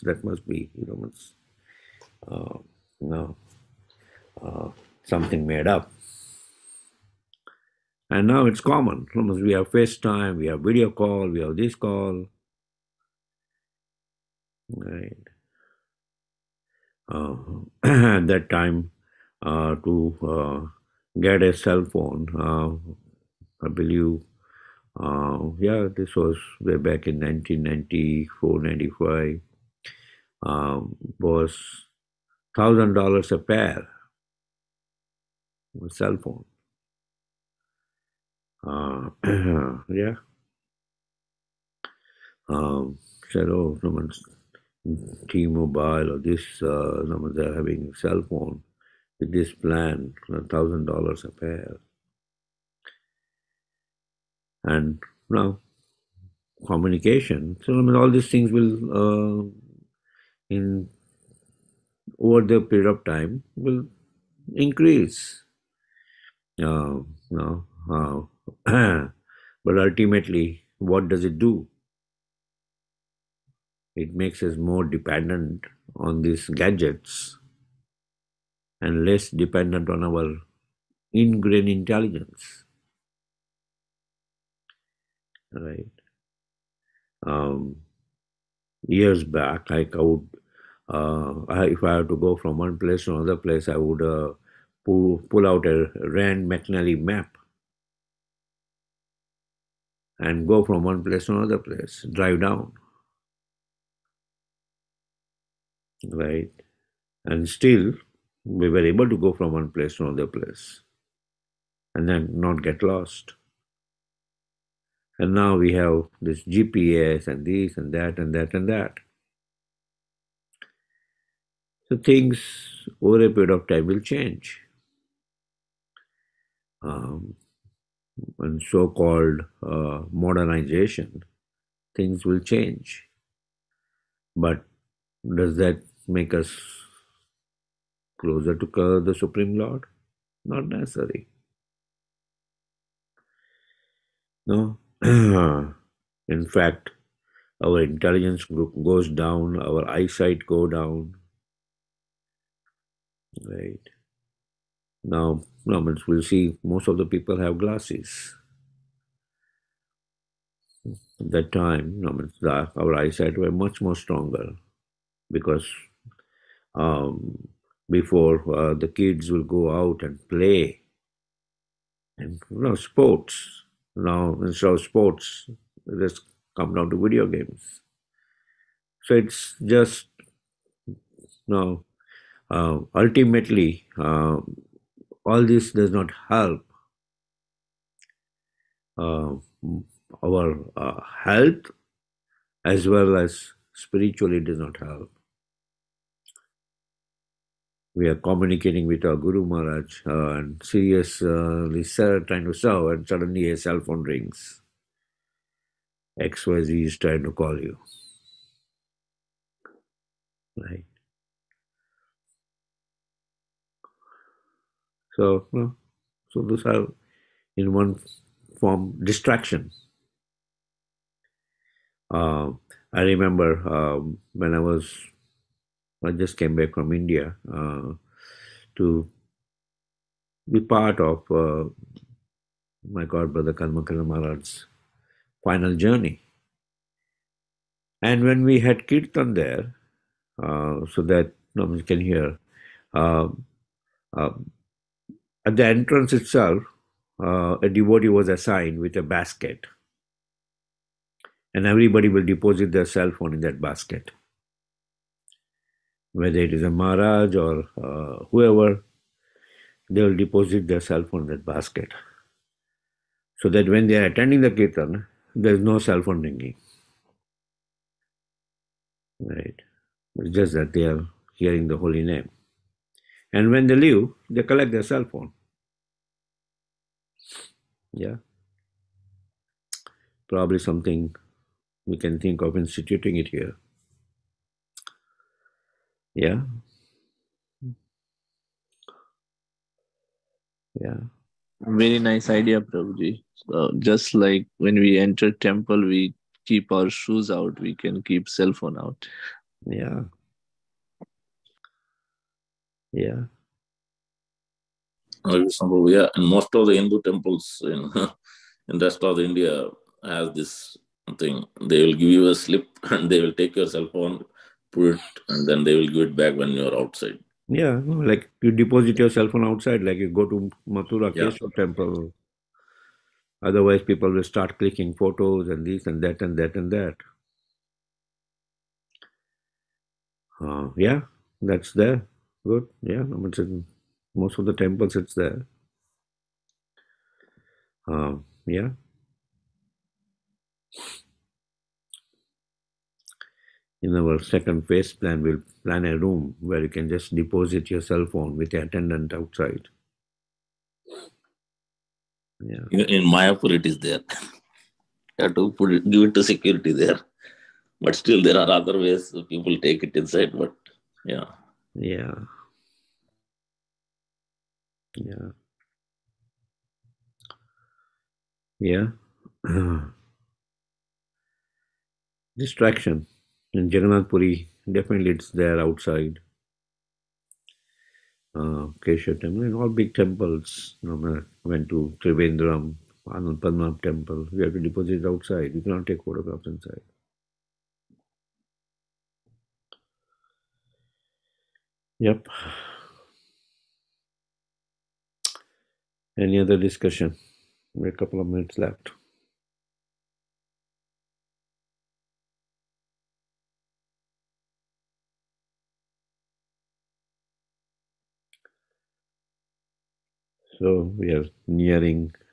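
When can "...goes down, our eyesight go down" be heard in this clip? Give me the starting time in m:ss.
2:28.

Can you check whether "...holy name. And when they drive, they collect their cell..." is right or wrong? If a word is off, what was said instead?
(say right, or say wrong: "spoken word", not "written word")
wrong: "leave", not "drive".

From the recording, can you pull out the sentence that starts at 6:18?
Uh, Kesha temple in all big temples.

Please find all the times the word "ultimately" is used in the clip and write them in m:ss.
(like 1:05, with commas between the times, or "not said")
1:09, 3:02.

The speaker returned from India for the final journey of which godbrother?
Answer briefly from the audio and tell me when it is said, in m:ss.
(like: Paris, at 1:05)
Kalmakala Maharaj, at 3:53.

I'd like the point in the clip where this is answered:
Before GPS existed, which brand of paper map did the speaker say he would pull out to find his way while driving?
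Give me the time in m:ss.
1:35.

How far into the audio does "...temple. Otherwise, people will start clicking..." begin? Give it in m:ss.
5:21.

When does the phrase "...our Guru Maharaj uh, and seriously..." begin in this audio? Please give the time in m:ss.
3:19.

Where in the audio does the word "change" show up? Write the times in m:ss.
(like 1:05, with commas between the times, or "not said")
2:03, 2:12.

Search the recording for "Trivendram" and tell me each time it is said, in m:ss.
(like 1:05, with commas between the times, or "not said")
6:22.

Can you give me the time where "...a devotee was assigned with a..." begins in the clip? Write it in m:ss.
4:07.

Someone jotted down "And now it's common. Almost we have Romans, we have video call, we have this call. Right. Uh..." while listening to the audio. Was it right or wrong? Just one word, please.
wrong.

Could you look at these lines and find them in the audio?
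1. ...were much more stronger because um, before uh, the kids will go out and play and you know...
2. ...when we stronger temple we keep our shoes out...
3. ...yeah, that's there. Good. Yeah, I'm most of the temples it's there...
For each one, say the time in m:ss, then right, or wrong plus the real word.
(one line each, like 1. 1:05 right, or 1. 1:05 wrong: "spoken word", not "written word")
1. 2:43 right
2. 4:54 wrong: "enter", not "stronger"
3. 5:30 right.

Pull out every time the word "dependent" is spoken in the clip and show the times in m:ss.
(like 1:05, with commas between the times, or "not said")
1:14, 1:19.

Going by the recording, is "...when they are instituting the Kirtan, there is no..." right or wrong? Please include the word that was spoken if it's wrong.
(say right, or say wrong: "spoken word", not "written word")
wrong: "attending", not "instituting".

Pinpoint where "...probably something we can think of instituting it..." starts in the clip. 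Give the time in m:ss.
4:40.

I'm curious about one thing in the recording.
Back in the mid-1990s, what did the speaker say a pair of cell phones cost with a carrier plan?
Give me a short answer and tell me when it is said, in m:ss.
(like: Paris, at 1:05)
$1,000, at 0:32.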